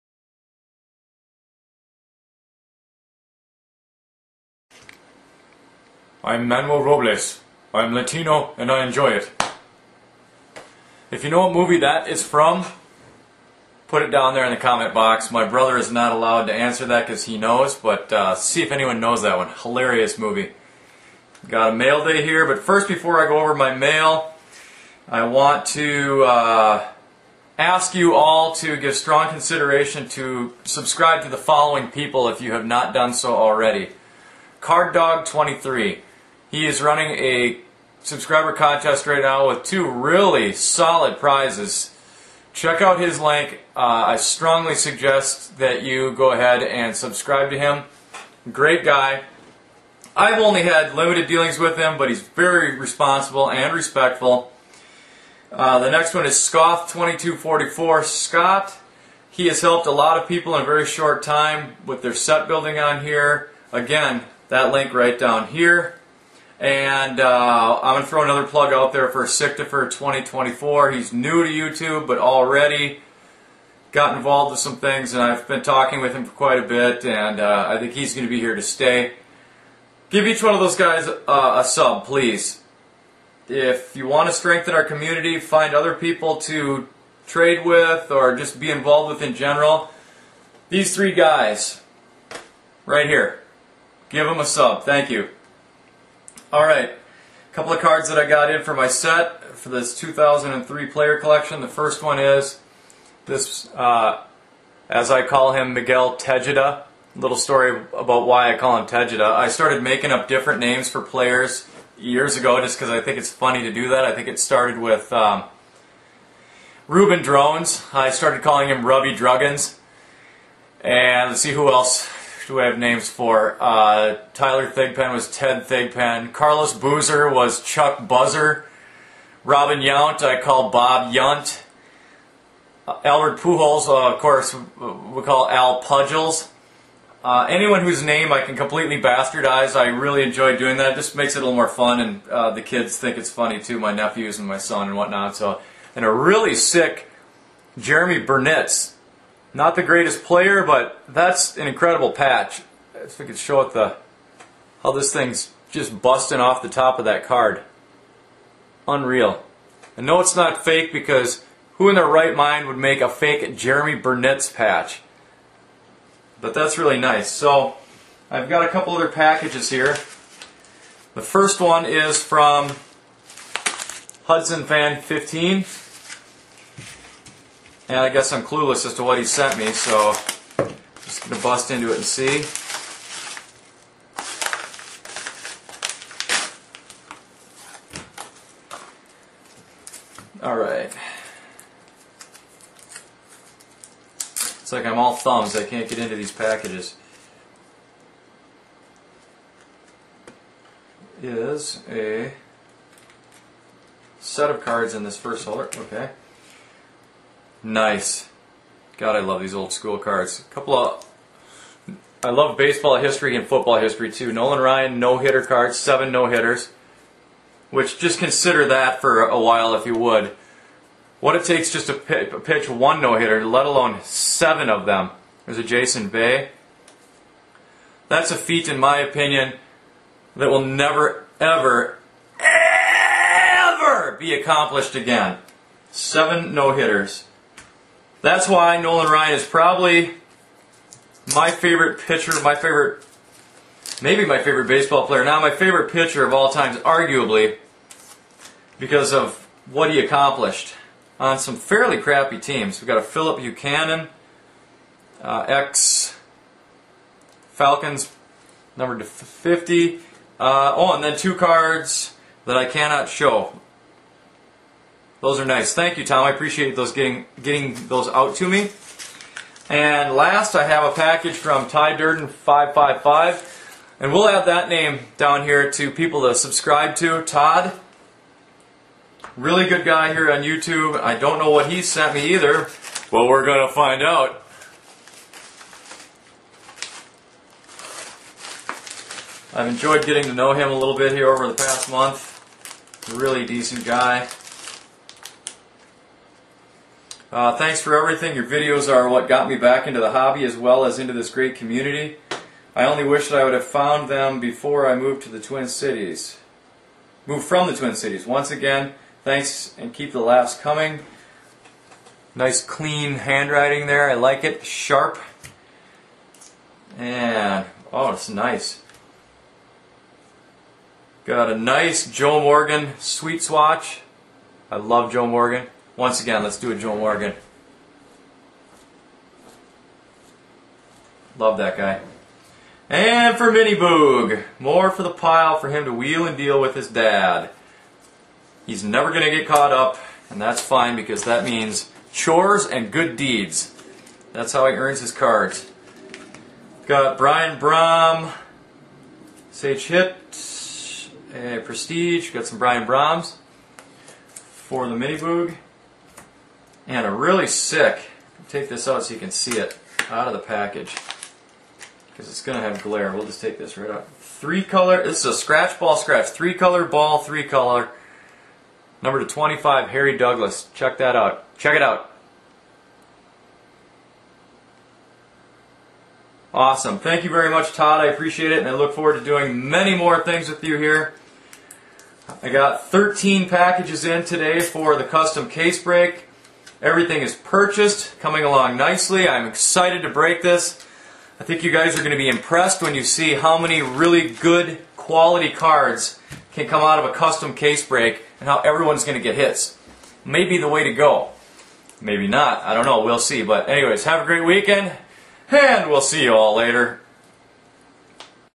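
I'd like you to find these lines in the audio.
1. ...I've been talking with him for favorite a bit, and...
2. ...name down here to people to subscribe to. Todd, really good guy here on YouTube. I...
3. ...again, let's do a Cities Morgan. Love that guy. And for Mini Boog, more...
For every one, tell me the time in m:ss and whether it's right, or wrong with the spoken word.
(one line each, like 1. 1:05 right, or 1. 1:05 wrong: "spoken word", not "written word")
1. 1:15 wrong: "quite", not "favorite"
2. 4:34 right
3. 5:26 wrong: "Joe", not "Cities".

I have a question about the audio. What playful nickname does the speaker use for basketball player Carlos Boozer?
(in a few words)
Chuck Buzzer.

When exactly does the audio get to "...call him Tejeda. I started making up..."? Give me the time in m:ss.
1:48.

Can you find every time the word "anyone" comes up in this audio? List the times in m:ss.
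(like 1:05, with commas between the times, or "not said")
0:18, 2:17.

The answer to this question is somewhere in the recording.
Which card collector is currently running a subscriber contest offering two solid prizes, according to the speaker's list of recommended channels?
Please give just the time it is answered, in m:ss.
0:34.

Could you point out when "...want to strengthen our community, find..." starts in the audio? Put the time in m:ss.
1:24.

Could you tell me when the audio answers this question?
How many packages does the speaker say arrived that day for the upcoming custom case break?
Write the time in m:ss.
6:22.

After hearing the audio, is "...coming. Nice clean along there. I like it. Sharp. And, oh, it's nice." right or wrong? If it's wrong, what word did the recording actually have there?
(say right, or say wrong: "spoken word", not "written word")
wrong: "handwriting", not "along".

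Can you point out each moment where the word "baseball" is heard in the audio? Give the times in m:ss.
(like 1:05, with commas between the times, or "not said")
3:32, 4:04.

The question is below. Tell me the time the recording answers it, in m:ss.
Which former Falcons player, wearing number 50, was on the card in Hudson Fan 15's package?
4:13.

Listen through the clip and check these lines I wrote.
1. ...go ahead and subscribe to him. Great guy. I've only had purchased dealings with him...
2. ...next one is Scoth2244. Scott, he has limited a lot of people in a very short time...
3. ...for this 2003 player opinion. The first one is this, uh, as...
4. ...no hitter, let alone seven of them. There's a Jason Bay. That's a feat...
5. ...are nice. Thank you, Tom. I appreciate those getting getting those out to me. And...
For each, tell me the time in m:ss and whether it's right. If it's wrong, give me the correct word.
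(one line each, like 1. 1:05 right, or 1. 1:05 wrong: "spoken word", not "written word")
1. 0:46 wrong: "limited", not "purchased"
2. 0:55 wrong: "helped", not "limited"
3. 1:39 wrong: "collection", not "opinion"
4. 3:42 right
5. 4:25 right.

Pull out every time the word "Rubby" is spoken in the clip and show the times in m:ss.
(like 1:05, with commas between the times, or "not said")
1:58.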